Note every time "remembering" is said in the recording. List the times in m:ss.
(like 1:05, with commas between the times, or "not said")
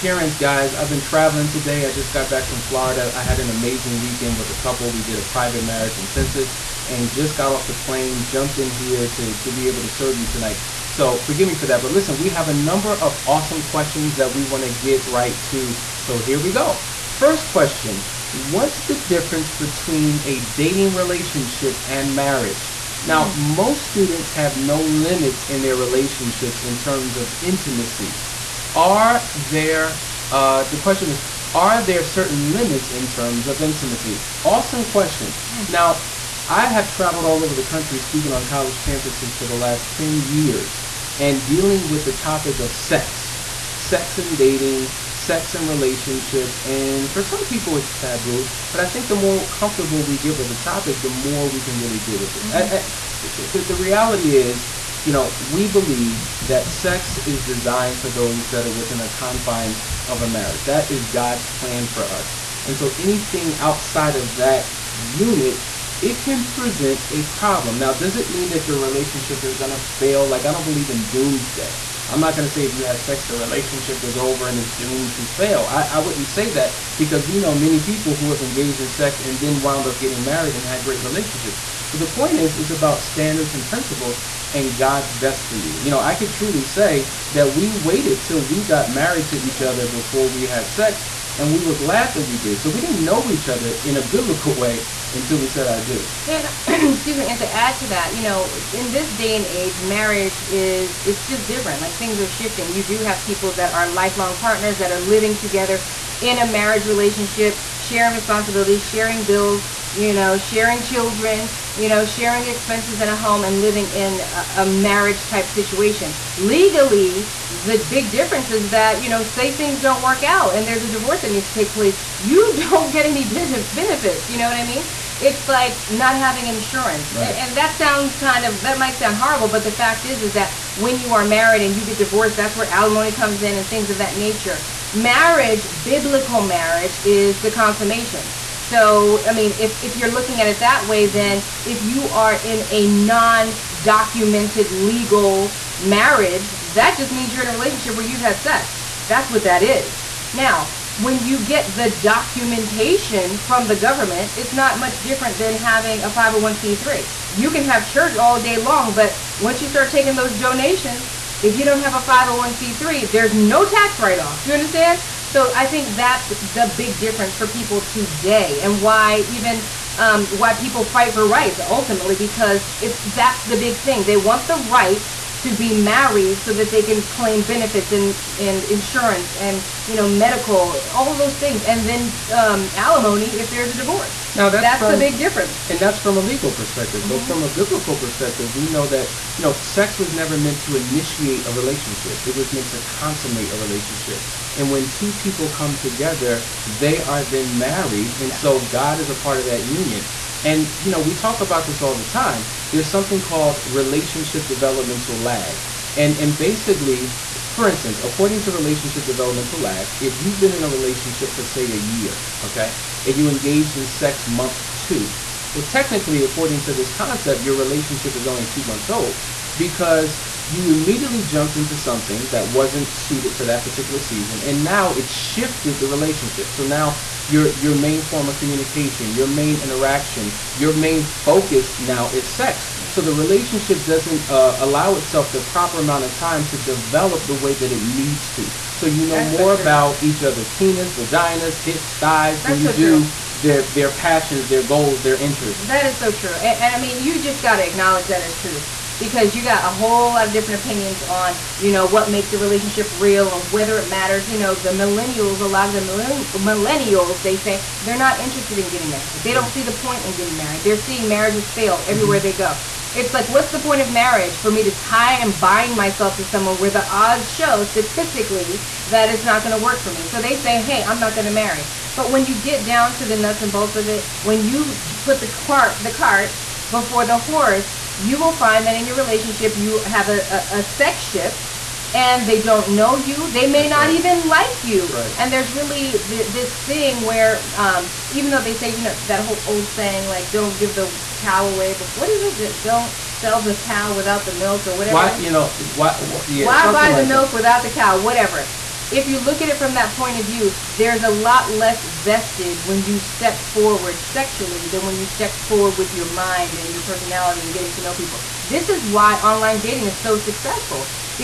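not said.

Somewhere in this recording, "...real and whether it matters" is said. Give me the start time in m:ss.
4:12.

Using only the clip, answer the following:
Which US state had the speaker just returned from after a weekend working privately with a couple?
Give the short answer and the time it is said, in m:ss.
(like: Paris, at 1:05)
Florida, at 0:02.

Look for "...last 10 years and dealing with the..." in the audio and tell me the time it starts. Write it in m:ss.
0:39.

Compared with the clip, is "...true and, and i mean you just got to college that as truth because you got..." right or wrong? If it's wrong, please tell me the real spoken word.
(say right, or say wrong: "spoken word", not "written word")
wrong: "acknowledge", not "college".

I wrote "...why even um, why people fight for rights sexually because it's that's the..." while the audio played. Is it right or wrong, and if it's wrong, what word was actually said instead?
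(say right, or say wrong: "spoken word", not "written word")
wrong: "ultimately", not "sexually".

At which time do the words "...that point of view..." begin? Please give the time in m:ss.
4:59.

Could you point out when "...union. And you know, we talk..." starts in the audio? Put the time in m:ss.
3:19.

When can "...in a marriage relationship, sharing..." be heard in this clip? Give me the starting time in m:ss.
1:46.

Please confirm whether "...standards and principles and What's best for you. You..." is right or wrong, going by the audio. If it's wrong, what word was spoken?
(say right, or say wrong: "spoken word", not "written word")
wrong: "God", not "What".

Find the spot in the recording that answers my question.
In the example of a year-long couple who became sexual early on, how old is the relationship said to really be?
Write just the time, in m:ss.
3:38.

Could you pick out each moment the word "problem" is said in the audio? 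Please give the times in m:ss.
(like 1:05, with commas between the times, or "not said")
1:07.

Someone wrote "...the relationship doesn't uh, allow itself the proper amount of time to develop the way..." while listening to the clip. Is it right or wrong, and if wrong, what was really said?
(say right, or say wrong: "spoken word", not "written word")
right.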